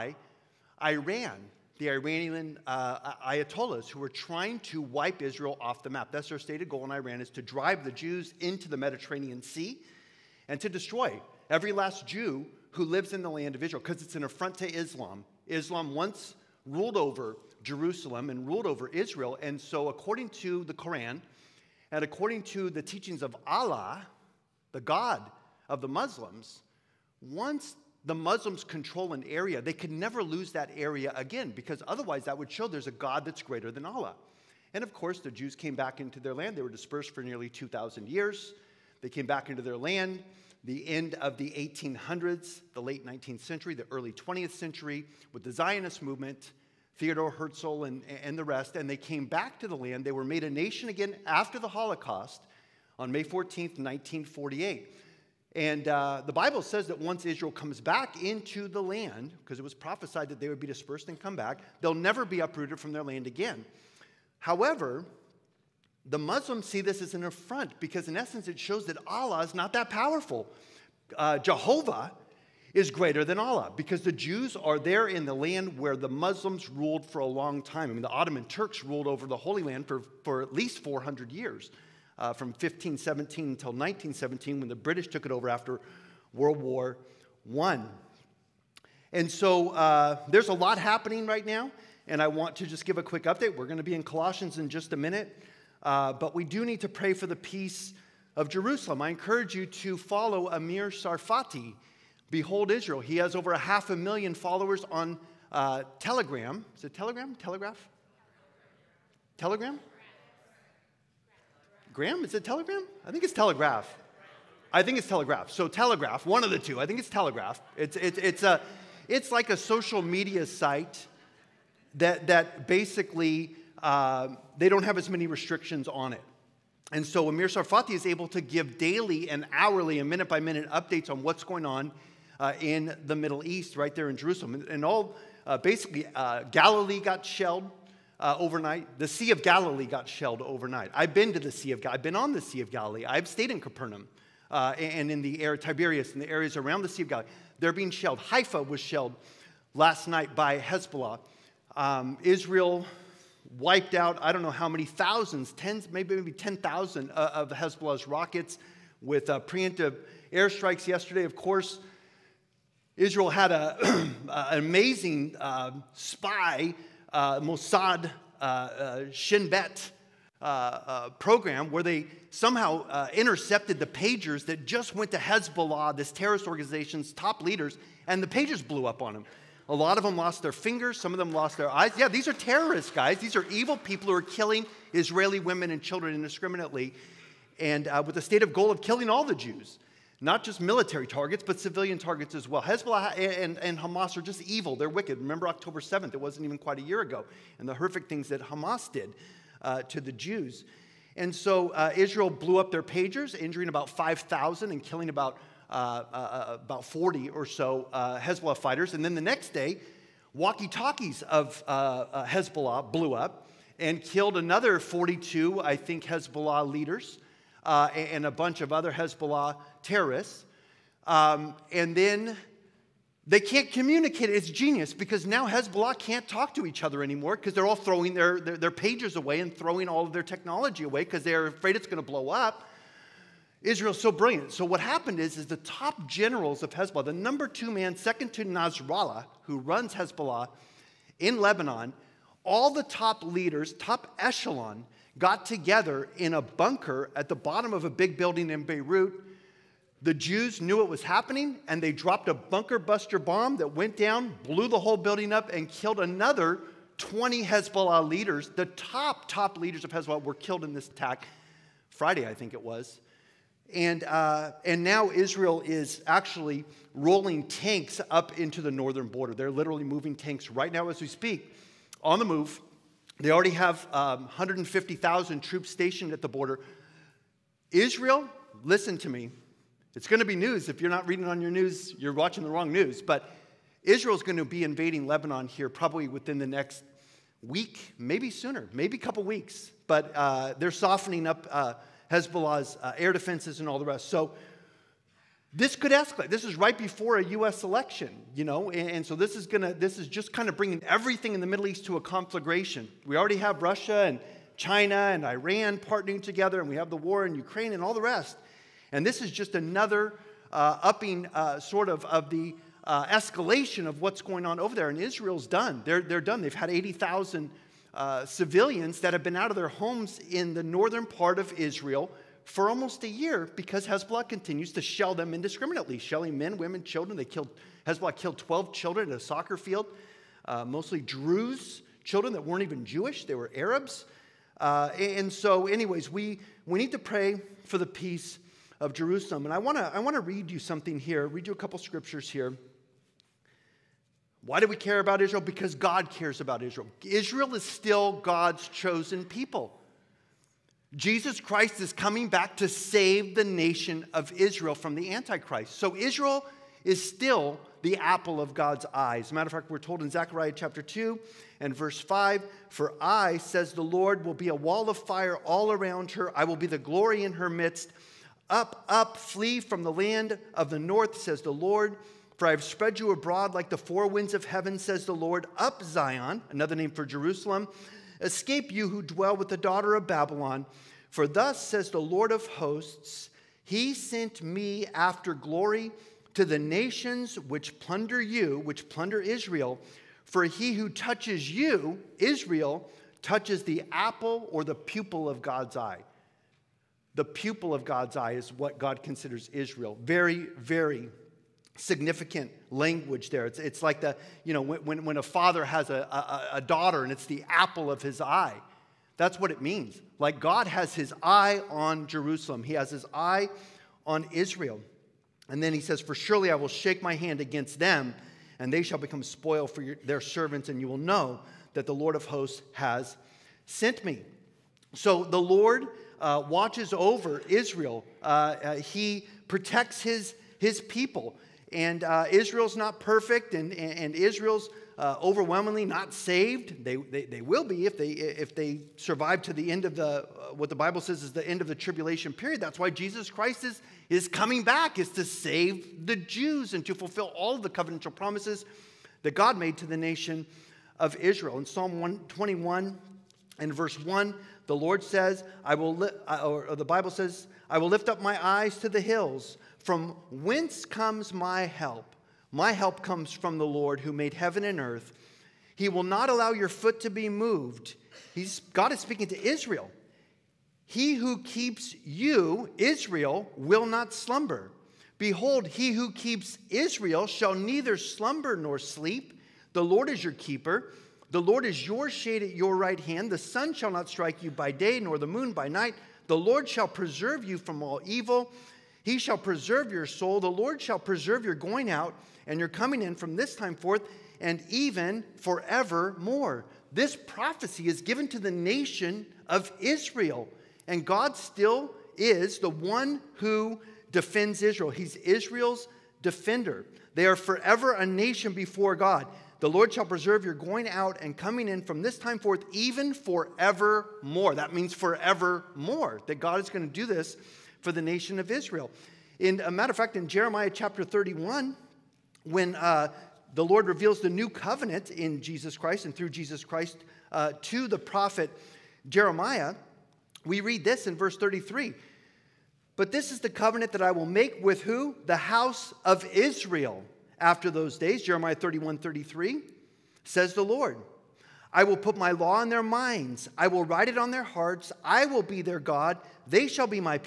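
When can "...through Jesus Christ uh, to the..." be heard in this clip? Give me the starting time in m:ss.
8:46.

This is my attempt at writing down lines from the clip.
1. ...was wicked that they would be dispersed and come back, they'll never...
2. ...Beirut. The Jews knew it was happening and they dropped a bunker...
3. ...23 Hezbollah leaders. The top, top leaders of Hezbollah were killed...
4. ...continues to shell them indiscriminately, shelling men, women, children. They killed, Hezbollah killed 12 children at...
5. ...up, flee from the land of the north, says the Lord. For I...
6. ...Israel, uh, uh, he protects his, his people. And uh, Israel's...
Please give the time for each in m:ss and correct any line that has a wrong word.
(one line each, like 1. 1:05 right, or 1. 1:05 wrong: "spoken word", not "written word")
1. 0:59 wrong: "prophesied", not "wicked"
2. 4:08 right
3. 4:16 wrong: "20", not "23"
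4. 5:24 right
5. 6:08 right
6. 7:07 right.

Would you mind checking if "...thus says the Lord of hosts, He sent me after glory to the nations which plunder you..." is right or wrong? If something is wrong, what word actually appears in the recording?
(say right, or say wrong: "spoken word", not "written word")
right.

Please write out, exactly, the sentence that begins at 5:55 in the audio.
So Israel is still the apple of God's eyes.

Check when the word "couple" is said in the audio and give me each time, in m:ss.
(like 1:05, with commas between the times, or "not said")
4:48, 5:41.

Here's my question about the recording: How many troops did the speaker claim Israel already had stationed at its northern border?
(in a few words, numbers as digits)
150,000.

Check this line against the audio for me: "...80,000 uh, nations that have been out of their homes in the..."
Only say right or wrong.
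wrong.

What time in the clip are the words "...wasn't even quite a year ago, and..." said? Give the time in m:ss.
3:16.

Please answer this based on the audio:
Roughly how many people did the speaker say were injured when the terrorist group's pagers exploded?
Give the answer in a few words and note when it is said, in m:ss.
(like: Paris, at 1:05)
5,000, at 3:23.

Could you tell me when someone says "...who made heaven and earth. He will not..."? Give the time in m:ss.
7:43.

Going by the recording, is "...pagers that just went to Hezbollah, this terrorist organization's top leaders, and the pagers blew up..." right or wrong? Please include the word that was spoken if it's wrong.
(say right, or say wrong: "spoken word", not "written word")
right.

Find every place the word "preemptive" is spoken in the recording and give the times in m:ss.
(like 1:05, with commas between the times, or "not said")
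2:39.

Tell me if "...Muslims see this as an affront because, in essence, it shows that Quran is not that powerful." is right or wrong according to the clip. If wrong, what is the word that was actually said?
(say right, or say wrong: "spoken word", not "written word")
wrong: "Allah", not "Quran".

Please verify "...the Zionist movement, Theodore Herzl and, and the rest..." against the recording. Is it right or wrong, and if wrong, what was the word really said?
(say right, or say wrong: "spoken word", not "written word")
right.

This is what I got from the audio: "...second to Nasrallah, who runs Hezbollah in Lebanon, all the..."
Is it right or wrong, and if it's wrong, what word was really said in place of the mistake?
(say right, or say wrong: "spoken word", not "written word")
right.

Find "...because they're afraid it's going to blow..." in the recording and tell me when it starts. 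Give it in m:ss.
3:51.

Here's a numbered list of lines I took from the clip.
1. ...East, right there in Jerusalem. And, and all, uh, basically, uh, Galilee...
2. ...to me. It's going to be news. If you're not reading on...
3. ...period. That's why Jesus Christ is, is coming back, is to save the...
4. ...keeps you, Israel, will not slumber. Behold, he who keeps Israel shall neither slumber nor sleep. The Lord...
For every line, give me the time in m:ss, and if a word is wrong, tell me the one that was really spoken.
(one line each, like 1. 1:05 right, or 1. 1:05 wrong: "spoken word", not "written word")
1. 2:13 right
2. 4:38 right
3. 7:22 right
4. 7:51 right.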